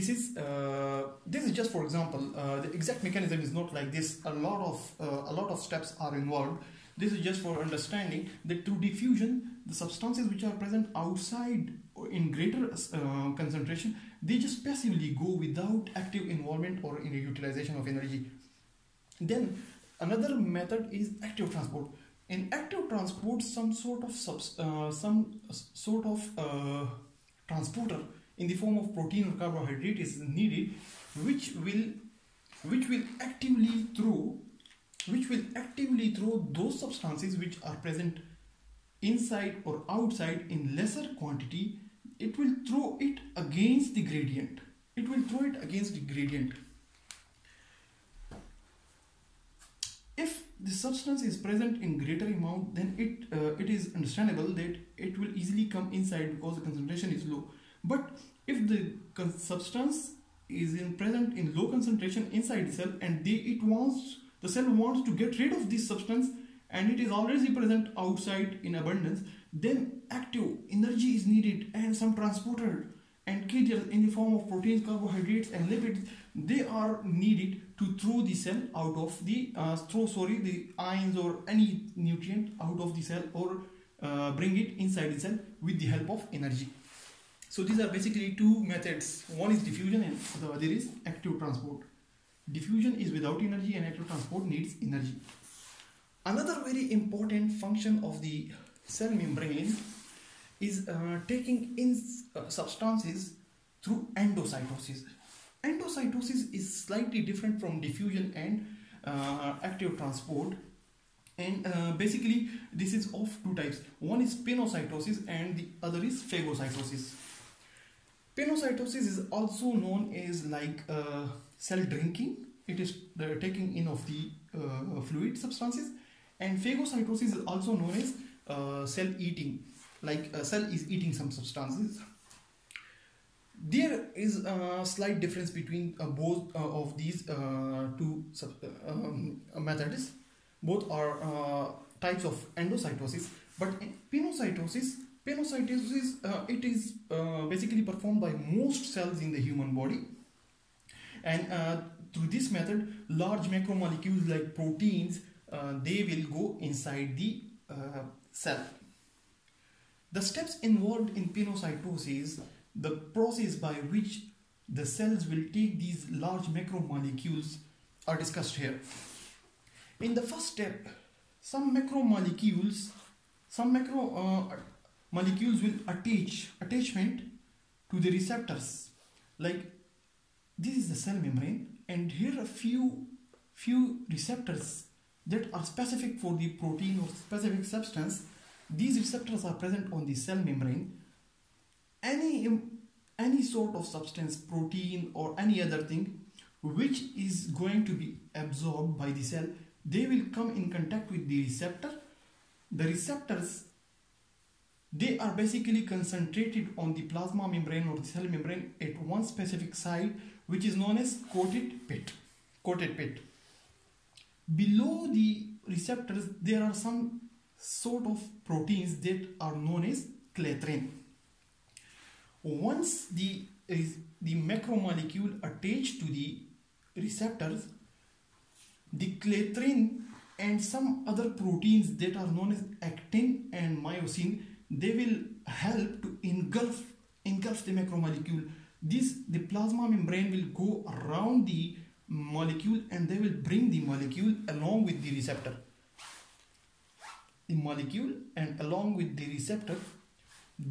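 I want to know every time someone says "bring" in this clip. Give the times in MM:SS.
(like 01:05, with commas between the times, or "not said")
01:24, 04:03.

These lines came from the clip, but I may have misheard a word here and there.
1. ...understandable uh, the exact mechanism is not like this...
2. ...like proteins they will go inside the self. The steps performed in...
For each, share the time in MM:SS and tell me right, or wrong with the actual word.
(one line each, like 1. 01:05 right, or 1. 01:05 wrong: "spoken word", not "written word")
1. 00:01 wrong: "example", not "understandable"
2. 02:34 wrong: "involved", not "performed".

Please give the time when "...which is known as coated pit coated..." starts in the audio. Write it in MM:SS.
03:30.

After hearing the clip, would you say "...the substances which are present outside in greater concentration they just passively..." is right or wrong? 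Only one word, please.
right.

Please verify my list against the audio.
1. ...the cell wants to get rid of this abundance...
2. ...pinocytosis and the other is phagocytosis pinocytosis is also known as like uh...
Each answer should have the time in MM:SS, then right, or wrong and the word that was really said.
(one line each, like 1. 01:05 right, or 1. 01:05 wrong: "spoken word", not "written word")
1. 01:04 wrong: "substance", not "abundance"
2. 01:54 right.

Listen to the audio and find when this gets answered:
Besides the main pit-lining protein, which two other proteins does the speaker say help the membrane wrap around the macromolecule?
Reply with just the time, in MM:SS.
03:52.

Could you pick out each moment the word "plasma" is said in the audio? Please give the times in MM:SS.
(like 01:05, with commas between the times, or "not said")
03:27, 03:59.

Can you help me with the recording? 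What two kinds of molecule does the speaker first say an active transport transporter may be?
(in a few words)
protein or carbohydrate.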